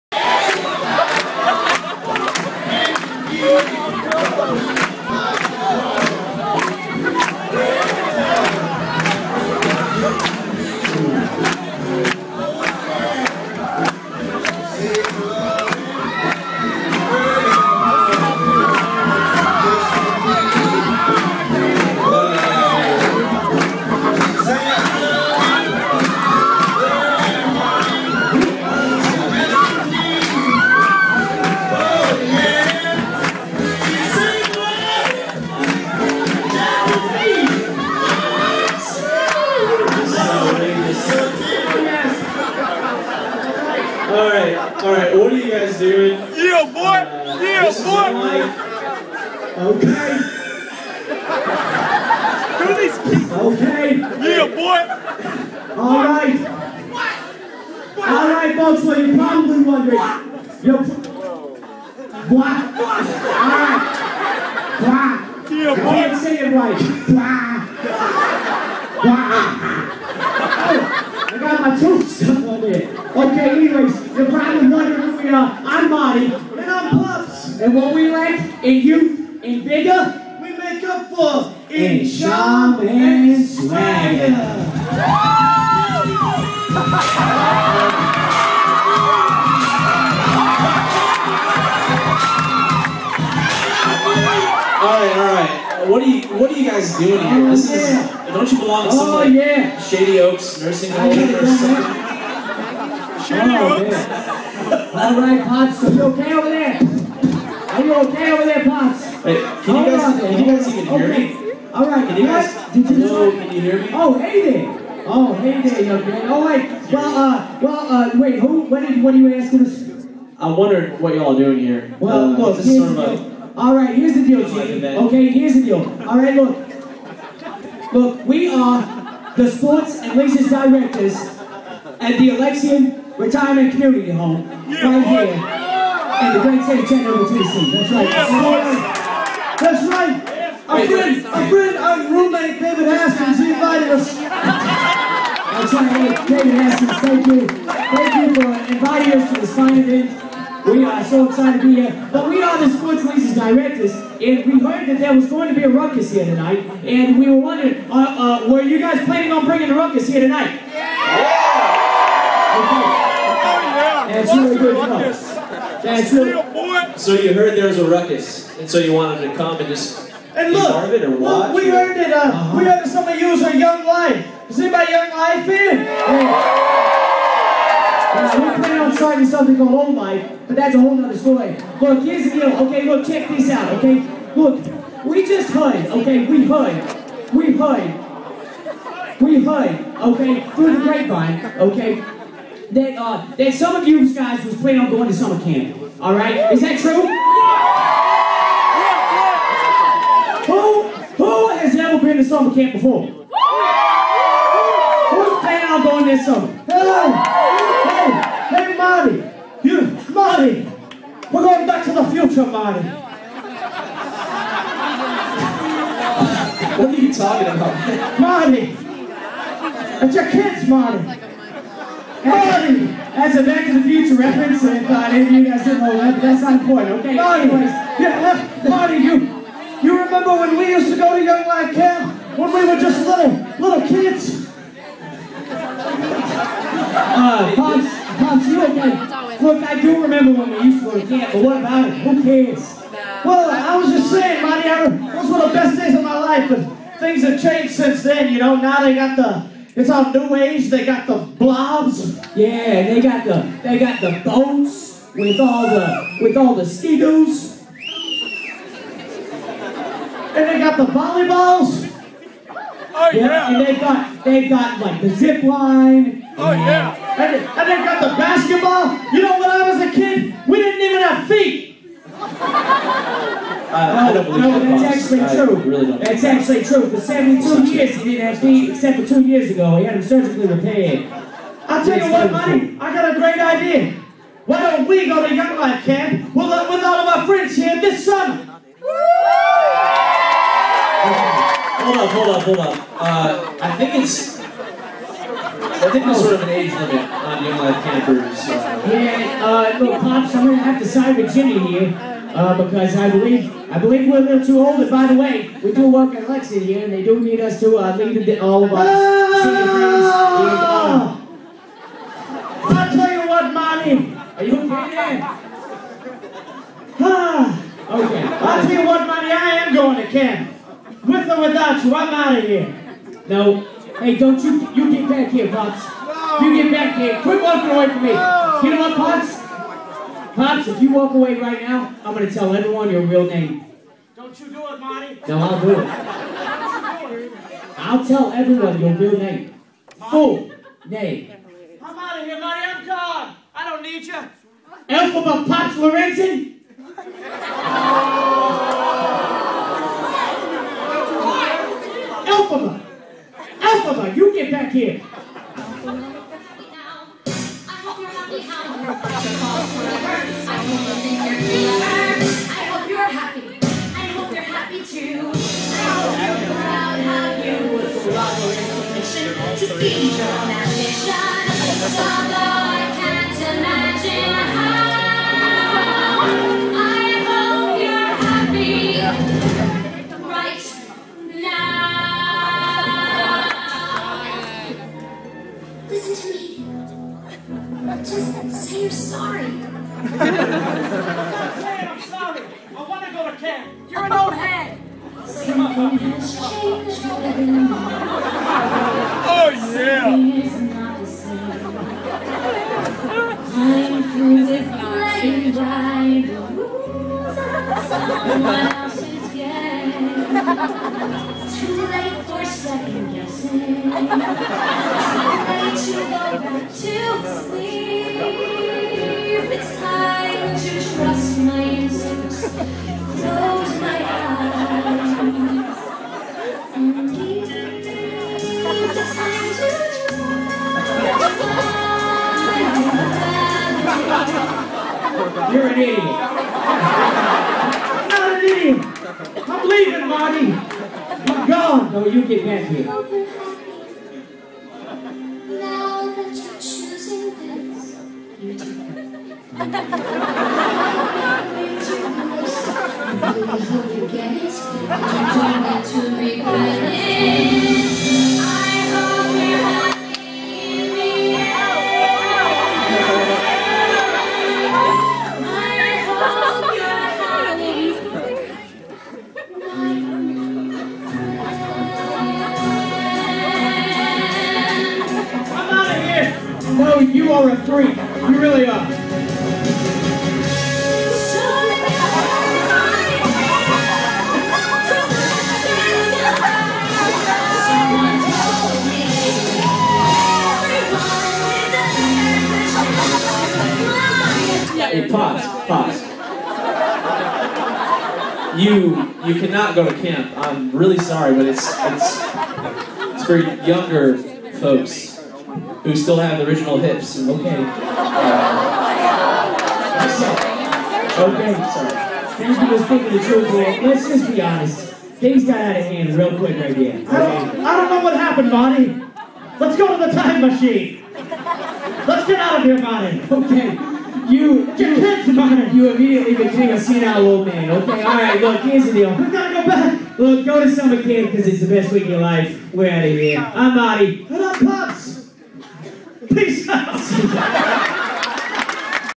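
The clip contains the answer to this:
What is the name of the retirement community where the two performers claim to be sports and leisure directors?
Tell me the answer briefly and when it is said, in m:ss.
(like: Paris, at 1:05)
Alexian Retirement Community Home, at 2:12.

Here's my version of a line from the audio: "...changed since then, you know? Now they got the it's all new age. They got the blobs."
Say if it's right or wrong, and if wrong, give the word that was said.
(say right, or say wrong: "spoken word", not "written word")
right.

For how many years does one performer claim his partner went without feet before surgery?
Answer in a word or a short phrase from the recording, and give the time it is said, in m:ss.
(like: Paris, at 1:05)
72, at 4:36.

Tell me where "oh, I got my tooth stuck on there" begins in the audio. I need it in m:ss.
1:10.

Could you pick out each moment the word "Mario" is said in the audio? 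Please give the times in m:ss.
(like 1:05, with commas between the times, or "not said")
not said.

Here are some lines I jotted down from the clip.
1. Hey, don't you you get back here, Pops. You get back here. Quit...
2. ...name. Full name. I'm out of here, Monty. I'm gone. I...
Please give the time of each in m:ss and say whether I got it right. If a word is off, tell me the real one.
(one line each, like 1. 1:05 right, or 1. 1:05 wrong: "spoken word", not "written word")
1. 5:23 right
2. 5:39 right.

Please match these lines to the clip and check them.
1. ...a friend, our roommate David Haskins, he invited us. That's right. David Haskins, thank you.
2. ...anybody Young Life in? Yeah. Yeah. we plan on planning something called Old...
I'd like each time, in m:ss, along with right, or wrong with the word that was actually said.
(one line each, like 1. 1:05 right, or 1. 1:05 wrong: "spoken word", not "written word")
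1. 2:21 right
2. 2:54 wrong: "starting", not "planning".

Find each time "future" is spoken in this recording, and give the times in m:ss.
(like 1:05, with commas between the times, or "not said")
3:32, 3:43.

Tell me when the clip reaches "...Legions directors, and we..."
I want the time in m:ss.
2:33.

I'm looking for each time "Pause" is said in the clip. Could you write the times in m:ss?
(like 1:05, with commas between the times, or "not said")
8:15.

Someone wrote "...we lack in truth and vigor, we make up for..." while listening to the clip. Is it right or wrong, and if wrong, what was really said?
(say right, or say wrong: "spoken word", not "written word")
wrong: "youth", not "truth".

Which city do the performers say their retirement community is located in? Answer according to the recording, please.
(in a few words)
Chattanooga.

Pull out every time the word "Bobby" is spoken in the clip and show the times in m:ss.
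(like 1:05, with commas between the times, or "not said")
3:47.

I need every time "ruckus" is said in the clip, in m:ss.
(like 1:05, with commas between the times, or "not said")
2:35, 2:39, 2:47.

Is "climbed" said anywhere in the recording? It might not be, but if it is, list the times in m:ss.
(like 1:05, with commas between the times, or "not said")
not said.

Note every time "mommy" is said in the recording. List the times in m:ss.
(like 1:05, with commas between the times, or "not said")
5:13, 5:19.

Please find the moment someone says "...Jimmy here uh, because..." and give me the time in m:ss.
5:01.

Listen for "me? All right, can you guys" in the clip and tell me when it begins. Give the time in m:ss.
1:51.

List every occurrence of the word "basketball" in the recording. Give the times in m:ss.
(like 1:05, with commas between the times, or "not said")
4:28.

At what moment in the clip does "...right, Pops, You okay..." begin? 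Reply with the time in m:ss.
1:45.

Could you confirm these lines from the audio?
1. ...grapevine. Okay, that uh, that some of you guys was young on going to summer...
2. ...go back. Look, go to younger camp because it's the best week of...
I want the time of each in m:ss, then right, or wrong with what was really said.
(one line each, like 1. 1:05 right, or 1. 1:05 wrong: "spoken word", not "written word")
1. 3:10 wrong: "planning", not "young"
2. 8:49 wrong: "summer", not "younger".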